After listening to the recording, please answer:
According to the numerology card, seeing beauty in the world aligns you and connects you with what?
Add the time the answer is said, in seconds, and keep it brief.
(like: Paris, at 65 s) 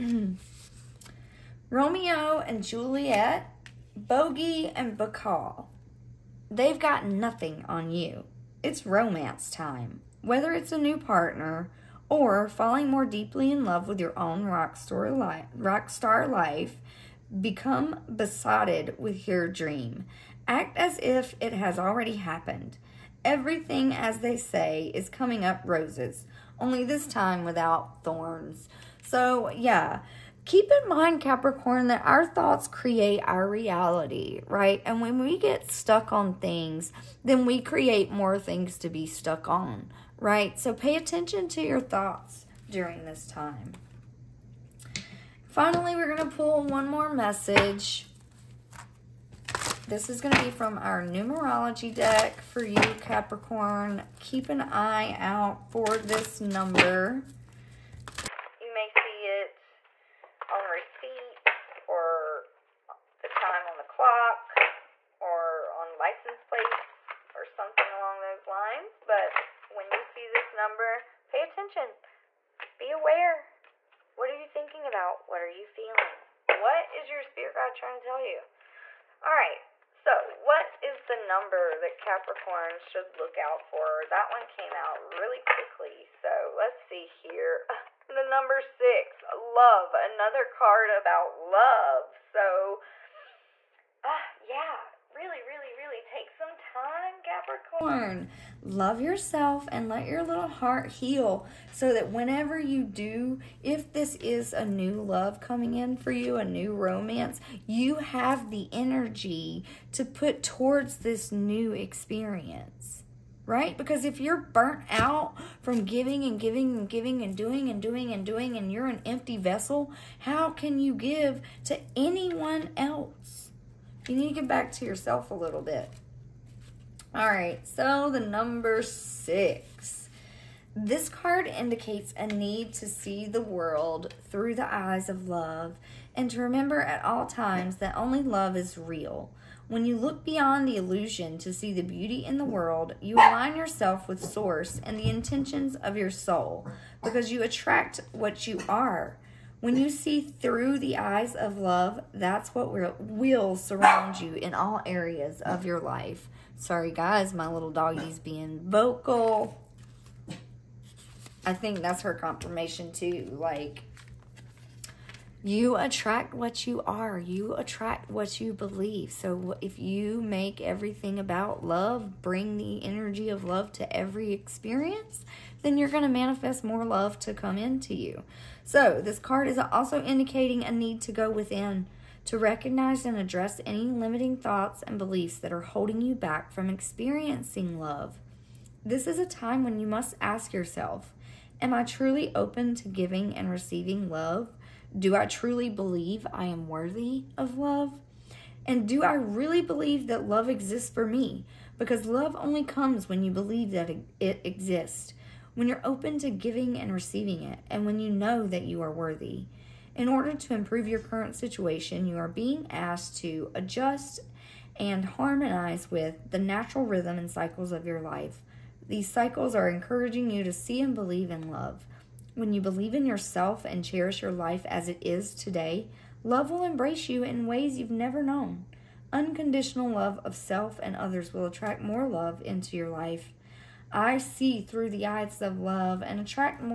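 Source, at 144 s.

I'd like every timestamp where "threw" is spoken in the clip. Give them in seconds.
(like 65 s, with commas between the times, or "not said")
not said.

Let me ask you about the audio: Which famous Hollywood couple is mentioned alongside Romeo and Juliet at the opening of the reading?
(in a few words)
Bogie and Bacall.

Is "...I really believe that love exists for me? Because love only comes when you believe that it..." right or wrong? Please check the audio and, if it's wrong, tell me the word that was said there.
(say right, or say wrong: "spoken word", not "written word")
right.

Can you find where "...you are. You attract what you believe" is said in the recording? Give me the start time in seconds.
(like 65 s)
166 s.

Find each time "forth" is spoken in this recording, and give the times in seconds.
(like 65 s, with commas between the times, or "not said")
not said.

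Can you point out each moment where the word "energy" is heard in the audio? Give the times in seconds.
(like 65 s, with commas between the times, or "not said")
108 s, 172 s.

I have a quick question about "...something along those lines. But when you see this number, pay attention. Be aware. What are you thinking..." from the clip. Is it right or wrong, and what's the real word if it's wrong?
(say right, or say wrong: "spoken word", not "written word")
right.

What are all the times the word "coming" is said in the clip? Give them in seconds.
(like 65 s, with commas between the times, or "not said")
25 s, 105 s.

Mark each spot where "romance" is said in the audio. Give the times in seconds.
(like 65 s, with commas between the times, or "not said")
8 s, 106 s.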